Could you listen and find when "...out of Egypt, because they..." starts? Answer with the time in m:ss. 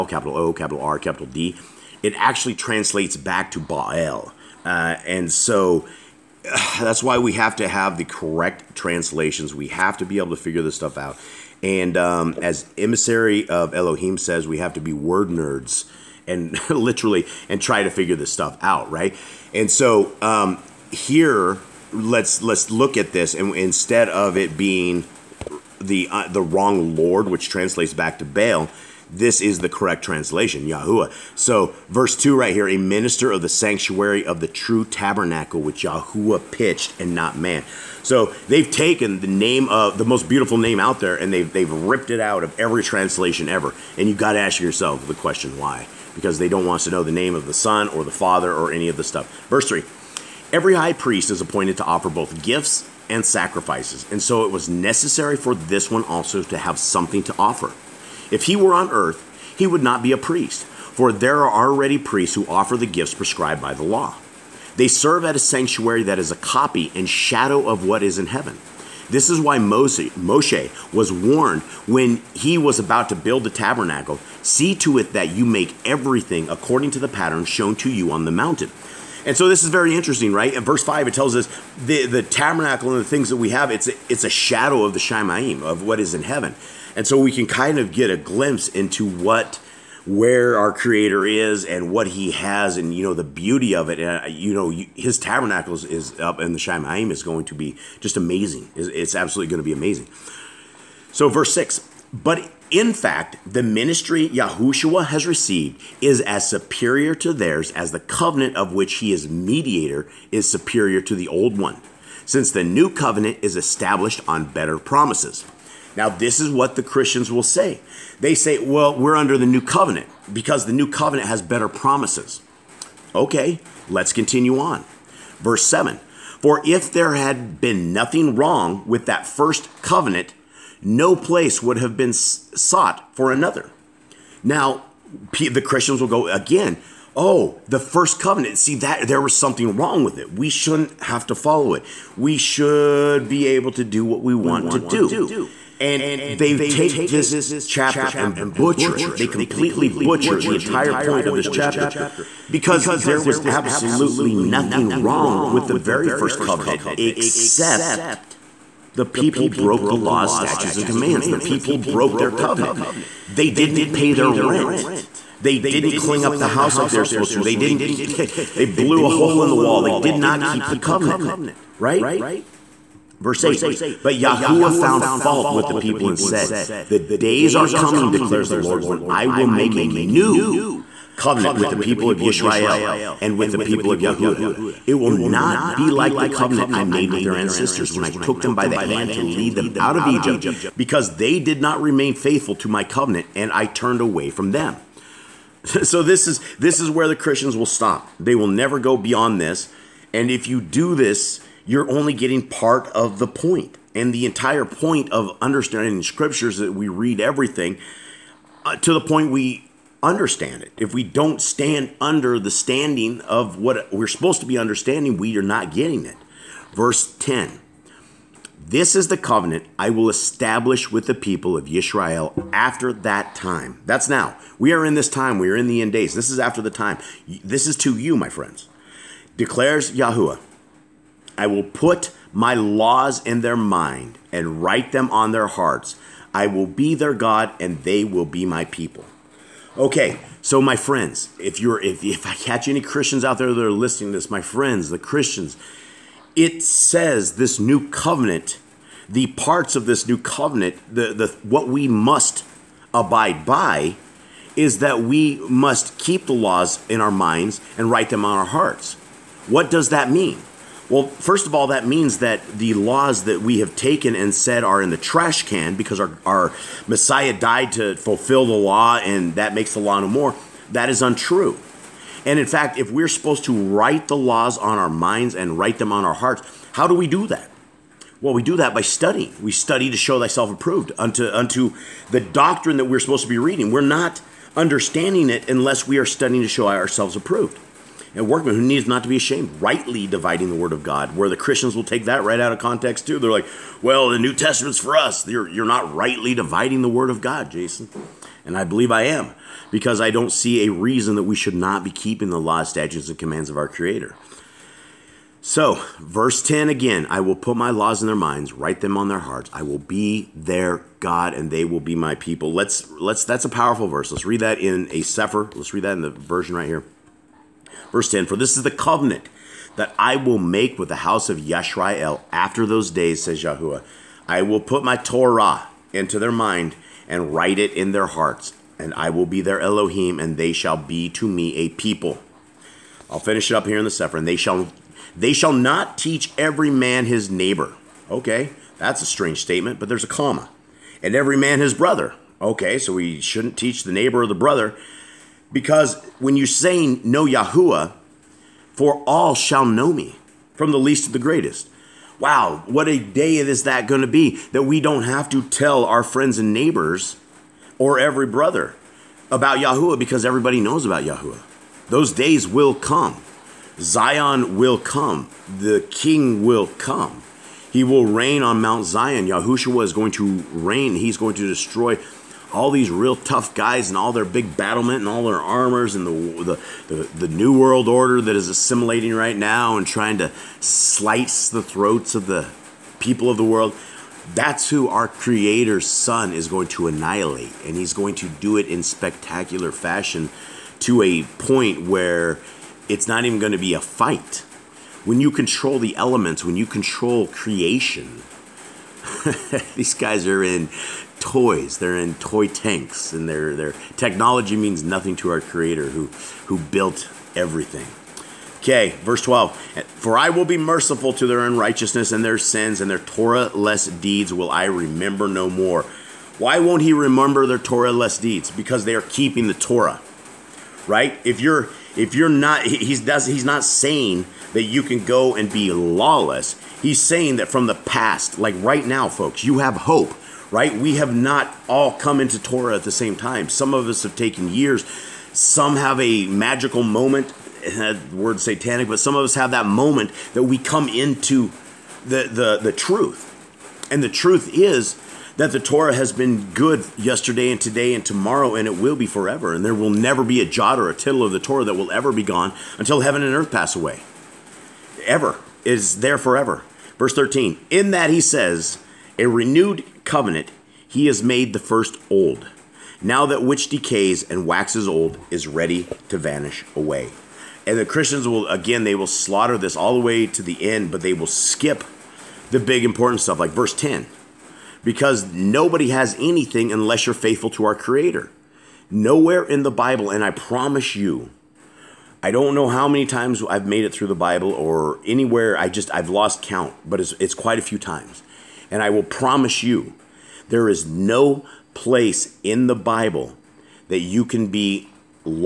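3:09.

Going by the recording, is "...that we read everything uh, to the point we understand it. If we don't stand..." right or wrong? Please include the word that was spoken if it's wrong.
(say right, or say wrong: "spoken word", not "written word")
right.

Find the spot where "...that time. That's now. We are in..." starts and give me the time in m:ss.
3:42.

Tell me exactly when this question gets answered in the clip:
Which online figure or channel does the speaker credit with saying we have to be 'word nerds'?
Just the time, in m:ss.
0:12.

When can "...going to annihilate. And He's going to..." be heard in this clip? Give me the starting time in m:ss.
6:26.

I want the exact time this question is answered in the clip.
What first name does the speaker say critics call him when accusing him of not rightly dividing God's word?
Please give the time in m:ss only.
4:57.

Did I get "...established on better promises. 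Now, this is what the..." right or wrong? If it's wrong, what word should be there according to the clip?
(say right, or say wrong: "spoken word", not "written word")
right.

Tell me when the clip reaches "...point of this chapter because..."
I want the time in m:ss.
2:30.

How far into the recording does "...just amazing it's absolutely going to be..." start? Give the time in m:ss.
1:38.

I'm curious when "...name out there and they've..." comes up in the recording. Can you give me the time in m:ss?
0:40.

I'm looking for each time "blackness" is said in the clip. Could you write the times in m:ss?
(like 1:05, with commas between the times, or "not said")
not said.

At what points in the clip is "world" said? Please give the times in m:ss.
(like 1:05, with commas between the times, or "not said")
6:17, 6:23.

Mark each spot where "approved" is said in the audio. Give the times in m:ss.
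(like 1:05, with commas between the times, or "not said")
4:40, 4:47.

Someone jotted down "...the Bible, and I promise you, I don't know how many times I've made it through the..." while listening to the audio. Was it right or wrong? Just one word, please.
right.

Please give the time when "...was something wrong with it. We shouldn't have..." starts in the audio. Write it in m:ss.
2:19.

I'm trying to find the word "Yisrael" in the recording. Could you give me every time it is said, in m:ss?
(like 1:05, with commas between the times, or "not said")
3:02.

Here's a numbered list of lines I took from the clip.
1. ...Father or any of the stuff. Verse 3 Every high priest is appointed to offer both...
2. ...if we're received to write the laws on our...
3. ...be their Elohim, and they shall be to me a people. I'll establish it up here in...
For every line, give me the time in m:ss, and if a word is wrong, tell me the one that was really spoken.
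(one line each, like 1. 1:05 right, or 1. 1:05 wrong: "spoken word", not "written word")
1. 0:48 right
2. 4:32 wrong: "supposed", not "received"
3. 5:29 wrong: "finish", not "establish".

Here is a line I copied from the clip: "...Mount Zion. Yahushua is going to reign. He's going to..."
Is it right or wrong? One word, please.
right.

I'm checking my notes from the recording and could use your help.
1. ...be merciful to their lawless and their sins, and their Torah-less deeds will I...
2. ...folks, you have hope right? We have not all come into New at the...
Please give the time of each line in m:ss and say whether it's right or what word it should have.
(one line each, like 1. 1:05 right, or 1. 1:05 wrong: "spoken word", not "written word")
1. 6:50 wrong: "unrighteousness", not "lawless"
2. 7:09 wrong: "Torah", not "New".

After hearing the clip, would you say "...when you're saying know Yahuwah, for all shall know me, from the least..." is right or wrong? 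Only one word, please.
right.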